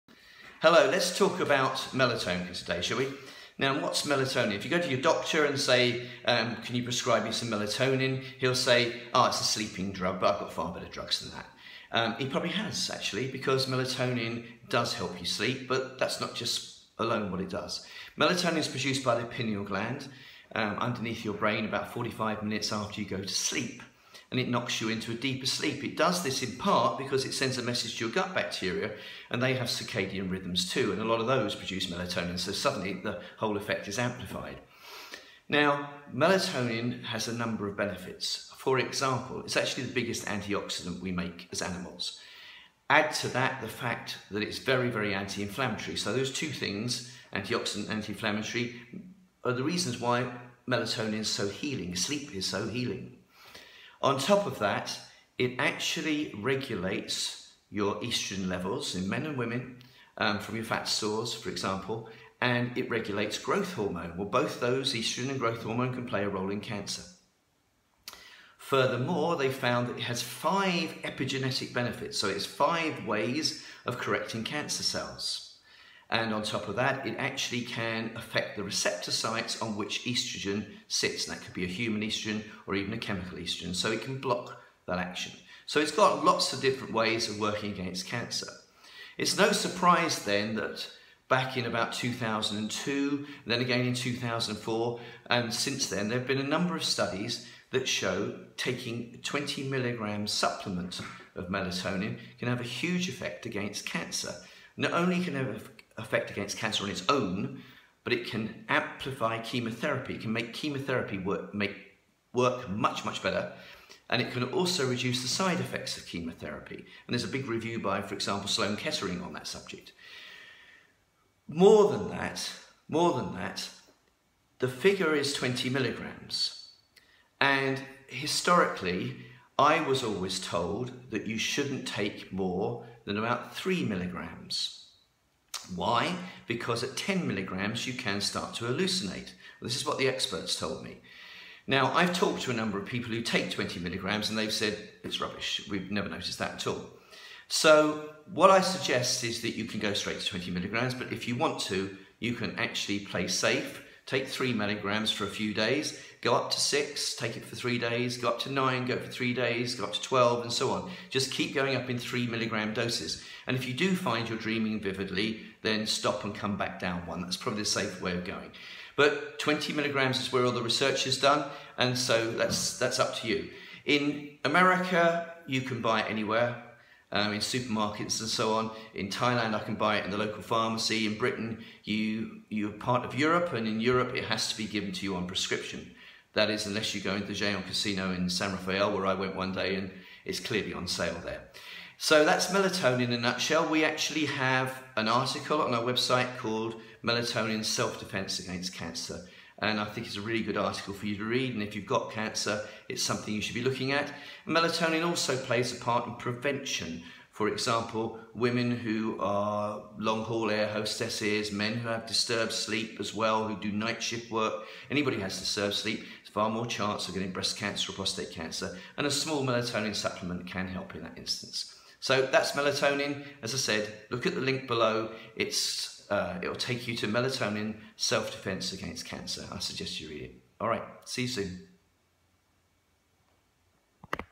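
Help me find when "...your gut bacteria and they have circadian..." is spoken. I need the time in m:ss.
0:28.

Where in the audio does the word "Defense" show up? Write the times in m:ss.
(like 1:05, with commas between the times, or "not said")
3:17, 3:48.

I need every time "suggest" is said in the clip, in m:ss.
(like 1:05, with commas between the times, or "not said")
2:28, 3:49.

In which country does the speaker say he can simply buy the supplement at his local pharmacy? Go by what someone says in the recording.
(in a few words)
Thailand.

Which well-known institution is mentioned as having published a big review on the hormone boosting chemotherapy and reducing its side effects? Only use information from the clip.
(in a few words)
Sloan Kettering.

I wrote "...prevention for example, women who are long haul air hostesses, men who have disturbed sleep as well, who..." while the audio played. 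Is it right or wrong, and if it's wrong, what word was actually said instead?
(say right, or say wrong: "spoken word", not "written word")
right.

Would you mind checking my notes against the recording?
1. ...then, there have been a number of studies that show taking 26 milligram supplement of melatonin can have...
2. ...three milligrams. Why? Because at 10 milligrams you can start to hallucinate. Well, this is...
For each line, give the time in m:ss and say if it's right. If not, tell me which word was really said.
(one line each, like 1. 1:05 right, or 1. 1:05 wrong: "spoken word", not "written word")
1. 1:35 wrong: "20", not "26"
2. 2:13 right.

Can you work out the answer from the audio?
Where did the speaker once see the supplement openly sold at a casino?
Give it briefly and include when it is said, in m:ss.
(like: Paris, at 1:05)
San Rafael, at 3:08.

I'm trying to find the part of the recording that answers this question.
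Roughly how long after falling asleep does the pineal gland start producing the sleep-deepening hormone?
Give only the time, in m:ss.
0:21.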